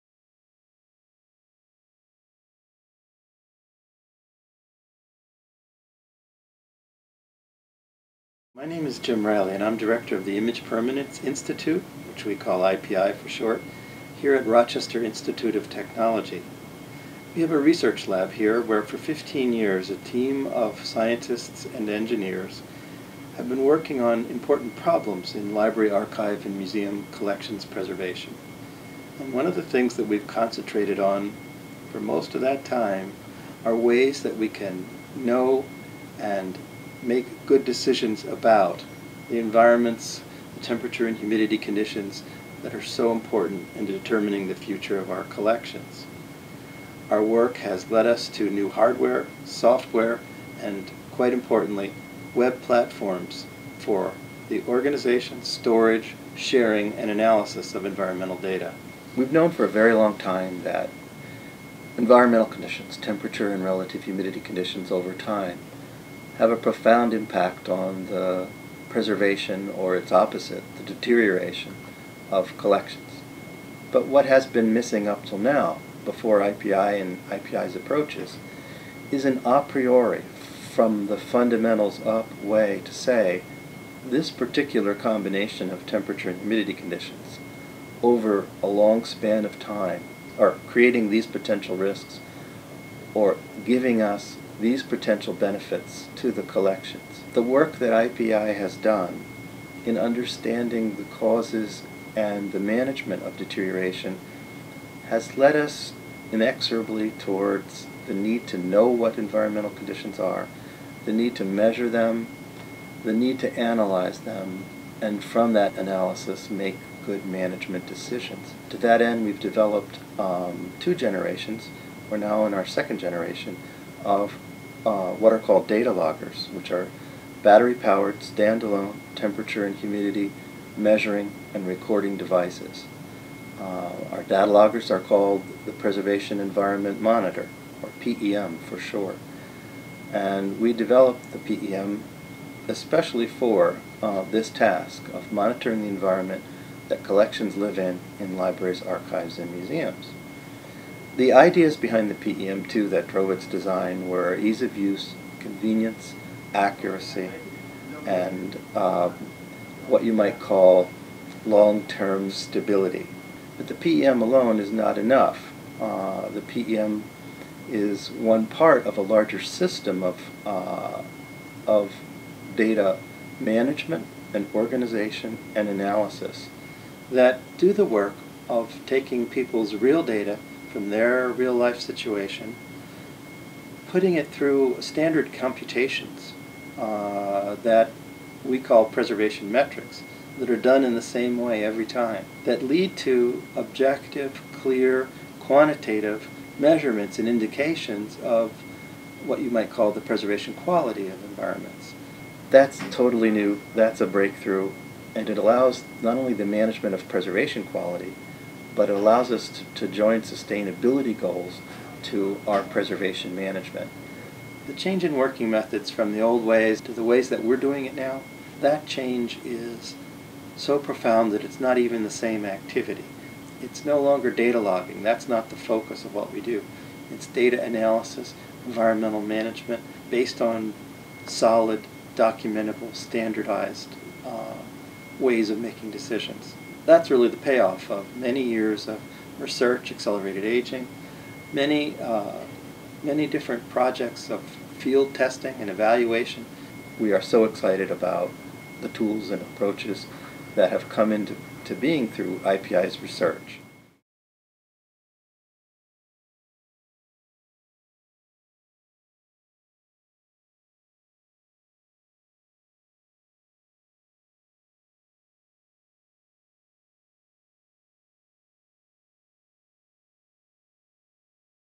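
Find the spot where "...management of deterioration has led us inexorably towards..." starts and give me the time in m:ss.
1:42.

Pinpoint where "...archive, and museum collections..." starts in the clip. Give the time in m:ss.
0:25.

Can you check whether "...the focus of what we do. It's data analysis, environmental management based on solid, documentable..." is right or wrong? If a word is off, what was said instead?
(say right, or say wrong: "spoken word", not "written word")
right.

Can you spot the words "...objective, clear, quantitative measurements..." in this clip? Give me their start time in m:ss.
3:13.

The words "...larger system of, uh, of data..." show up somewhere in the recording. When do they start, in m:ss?
2:49.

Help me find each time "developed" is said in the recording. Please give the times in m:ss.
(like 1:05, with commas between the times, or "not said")
1:59, 2:20.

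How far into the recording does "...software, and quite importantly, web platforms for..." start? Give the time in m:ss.
0:49.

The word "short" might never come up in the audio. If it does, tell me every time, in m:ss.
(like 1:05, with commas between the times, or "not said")
0:13, 2:18.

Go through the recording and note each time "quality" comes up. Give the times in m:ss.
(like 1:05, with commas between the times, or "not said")
3:20, 3:27.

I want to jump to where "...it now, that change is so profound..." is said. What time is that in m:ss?
3:37.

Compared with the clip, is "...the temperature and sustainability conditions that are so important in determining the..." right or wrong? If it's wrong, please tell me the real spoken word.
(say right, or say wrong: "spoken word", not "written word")
wrong: "humidity", not "sustainability".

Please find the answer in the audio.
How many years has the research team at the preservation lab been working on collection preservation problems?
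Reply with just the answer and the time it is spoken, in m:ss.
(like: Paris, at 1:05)
15, at 0:18.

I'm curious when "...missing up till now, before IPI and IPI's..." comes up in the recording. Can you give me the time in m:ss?
1:14.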